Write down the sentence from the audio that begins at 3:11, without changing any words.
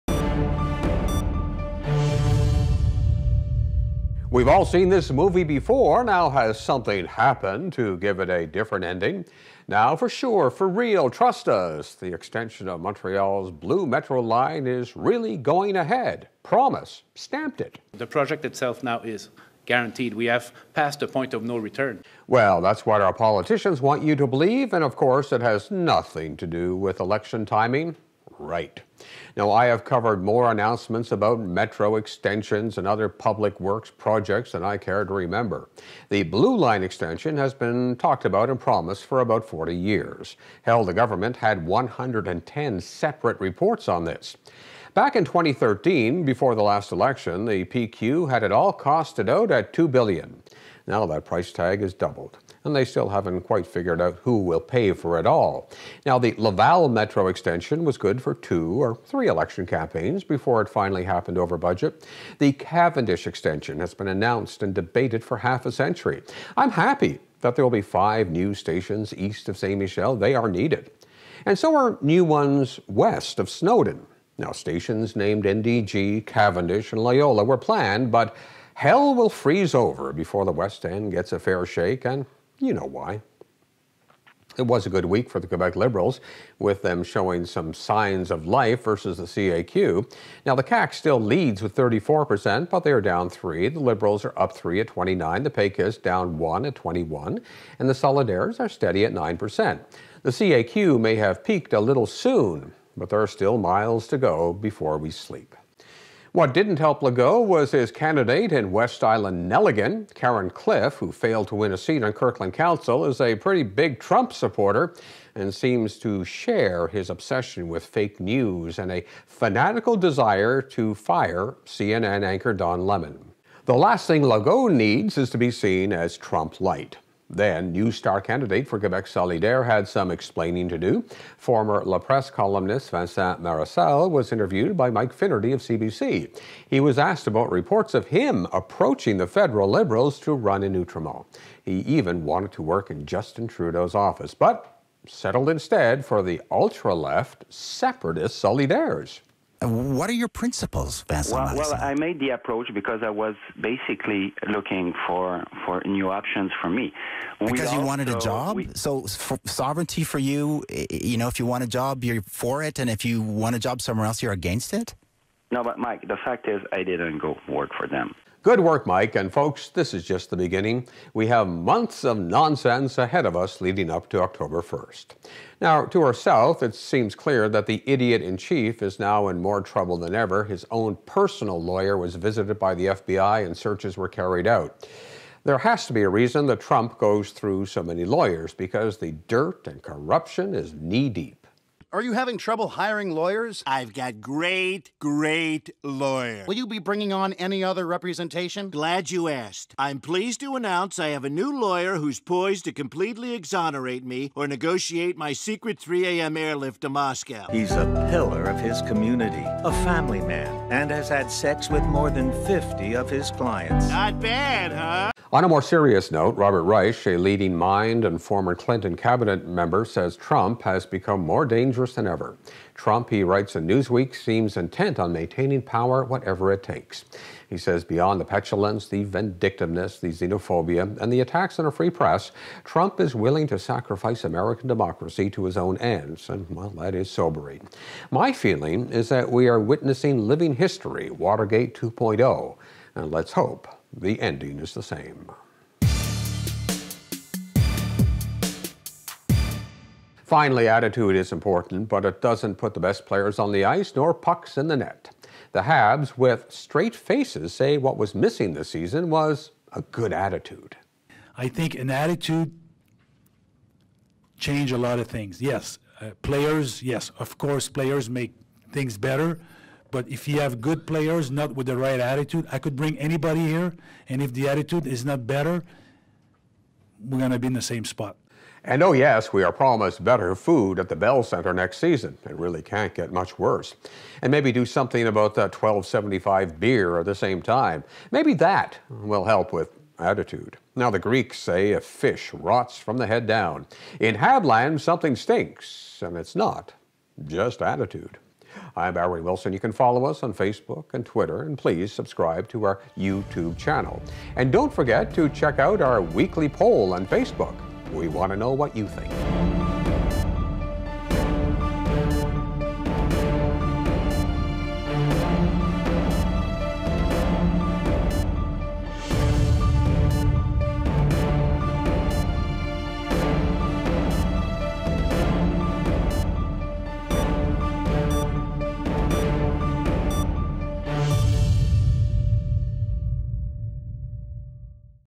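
Are you having trouble hiring lawyers?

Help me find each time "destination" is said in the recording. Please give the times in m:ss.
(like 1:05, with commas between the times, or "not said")
not said.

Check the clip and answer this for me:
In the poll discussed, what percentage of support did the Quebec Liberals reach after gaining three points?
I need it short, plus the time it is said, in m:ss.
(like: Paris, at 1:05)
29%, at 1:34.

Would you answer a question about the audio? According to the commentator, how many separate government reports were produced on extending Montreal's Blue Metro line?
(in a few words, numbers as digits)
110.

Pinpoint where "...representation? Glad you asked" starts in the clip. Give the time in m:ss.
3:17.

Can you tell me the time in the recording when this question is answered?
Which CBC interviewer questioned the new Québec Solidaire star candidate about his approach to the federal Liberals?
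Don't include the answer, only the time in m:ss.
2:14.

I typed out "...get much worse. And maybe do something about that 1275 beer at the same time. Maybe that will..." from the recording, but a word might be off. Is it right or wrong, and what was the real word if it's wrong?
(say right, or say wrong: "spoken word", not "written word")
right.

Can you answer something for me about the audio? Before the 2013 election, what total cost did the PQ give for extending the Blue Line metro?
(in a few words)
$2 billion.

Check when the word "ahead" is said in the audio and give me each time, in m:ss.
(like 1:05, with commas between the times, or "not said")
0:15, 2:52.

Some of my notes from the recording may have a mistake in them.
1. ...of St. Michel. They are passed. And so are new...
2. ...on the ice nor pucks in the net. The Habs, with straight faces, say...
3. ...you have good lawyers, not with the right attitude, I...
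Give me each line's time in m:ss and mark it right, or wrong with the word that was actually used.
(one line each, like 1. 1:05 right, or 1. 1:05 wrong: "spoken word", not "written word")
1. 1:09 wrong: "needed", not "passed"
2. 4:13 right
3. 4:30 wrong: "players", not "lawyers".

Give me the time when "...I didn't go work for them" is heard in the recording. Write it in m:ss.
2:46.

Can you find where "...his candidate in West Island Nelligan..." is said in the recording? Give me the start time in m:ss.
1:47.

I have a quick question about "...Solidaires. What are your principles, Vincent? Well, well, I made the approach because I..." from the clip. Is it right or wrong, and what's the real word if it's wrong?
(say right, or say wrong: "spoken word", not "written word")
right.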